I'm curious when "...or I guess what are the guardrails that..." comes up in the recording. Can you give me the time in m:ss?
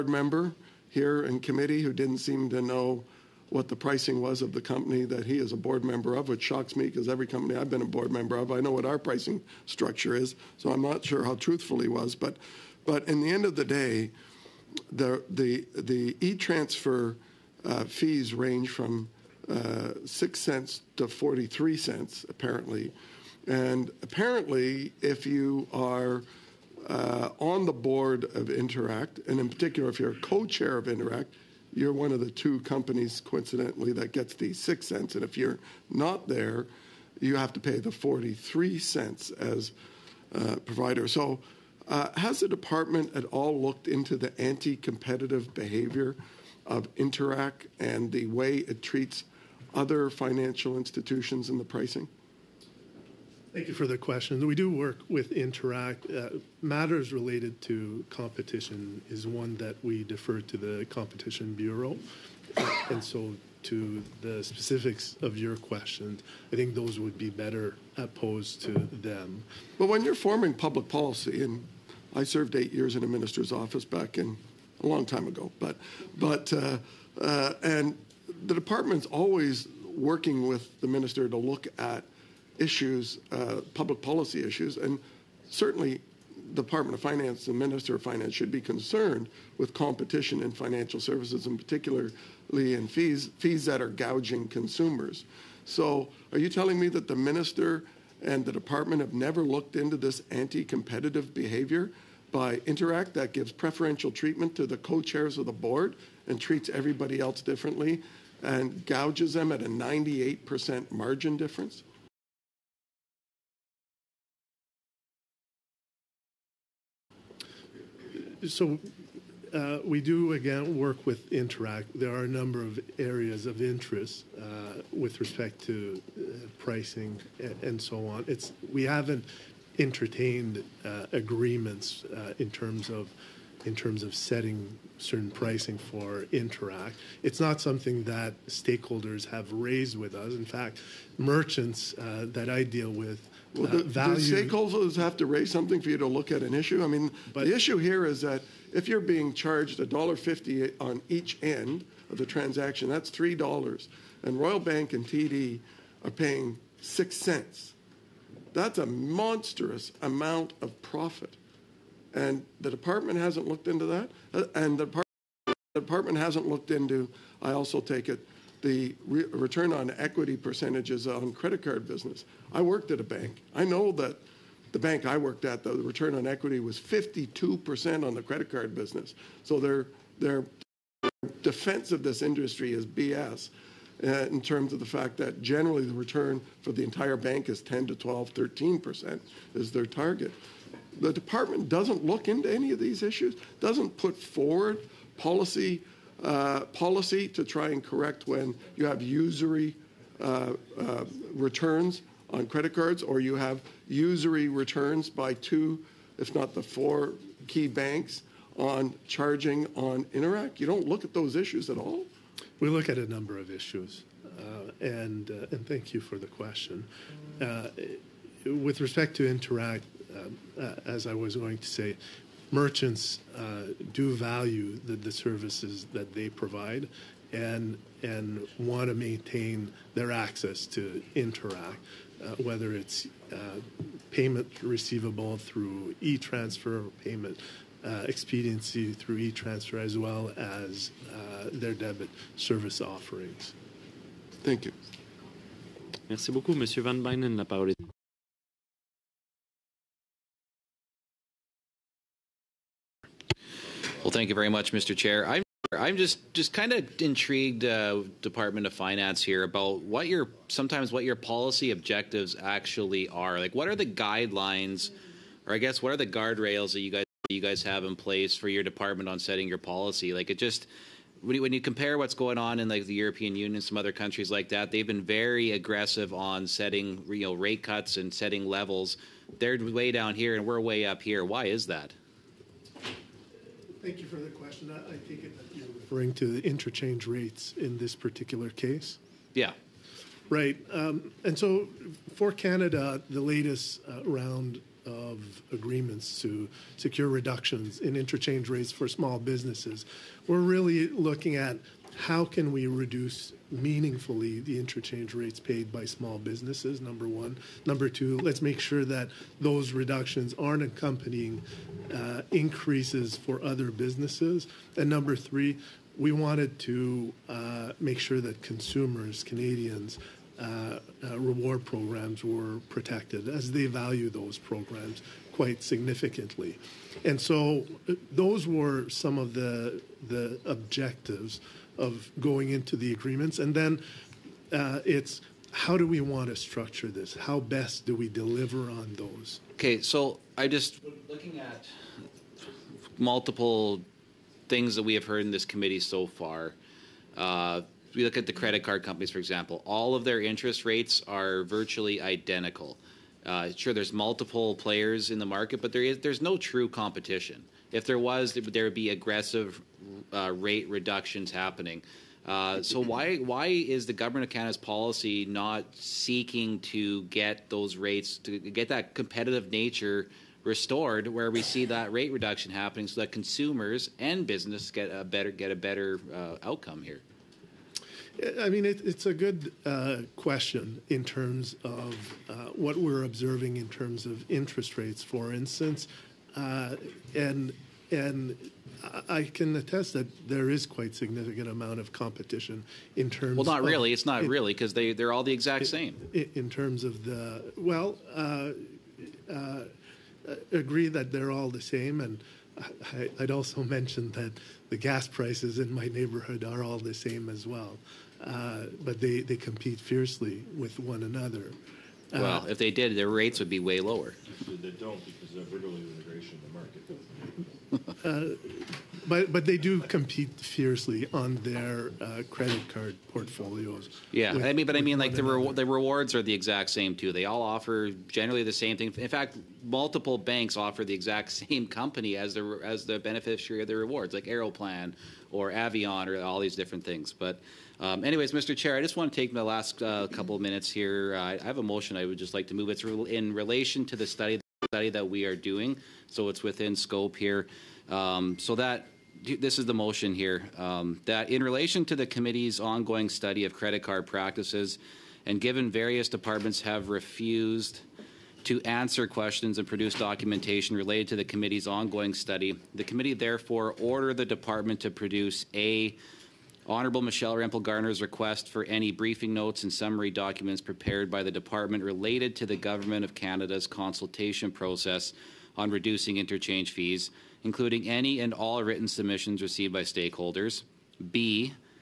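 4:25.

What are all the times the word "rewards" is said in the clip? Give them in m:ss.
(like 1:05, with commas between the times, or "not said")
5:21, 7:05, 7:13.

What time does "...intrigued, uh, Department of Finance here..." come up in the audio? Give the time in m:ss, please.
4:17.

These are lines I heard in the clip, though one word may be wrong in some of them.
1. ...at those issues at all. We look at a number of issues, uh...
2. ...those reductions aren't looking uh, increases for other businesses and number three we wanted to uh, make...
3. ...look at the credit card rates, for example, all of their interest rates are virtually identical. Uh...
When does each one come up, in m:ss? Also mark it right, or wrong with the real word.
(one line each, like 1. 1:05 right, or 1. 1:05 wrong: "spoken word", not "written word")
1. 3:31 right
2. 5:09 wrong: "accompanying", not "looking"
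3. 5:48 wrong: "companies", not "rates".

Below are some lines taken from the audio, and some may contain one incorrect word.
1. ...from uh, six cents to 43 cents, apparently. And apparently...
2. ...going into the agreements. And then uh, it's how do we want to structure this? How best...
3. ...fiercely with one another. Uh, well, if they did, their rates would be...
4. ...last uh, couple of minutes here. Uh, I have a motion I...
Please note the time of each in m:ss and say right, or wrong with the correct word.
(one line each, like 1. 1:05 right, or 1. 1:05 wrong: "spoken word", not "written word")
1. 0:18 right
2. 5:32 right
3. 6:49 right
4. 7:19 right.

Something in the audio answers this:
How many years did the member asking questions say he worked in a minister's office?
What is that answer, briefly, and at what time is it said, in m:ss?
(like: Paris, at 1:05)
8 years, at 1:12.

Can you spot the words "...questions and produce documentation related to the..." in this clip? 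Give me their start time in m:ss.
7:39.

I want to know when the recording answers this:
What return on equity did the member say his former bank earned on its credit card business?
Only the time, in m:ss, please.
2:56.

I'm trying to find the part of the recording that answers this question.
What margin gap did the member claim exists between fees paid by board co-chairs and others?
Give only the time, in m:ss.
1:49.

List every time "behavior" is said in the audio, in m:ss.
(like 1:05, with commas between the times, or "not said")
0:45, 1:41.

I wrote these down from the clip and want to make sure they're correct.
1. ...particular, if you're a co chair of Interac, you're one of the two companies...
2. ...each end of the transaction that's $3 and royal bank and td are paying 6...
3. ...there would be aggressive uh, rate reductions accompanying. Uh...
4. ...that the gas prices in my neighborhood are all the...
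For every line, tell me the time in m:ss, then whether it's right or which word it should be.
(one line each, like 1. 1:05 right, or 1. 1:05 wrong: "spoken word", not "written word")
1. 0:29 right
2. 2:31 right
3. 5:58 wrong: "happening", not "accompanying"
4. 6:44 right.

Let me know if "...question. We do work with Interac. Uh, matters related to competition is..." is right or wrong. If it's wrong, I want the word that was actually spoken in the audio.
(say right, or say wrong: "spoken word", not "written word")
right.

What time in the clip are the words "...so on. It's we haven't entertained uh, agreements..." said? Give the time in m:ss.
2:07.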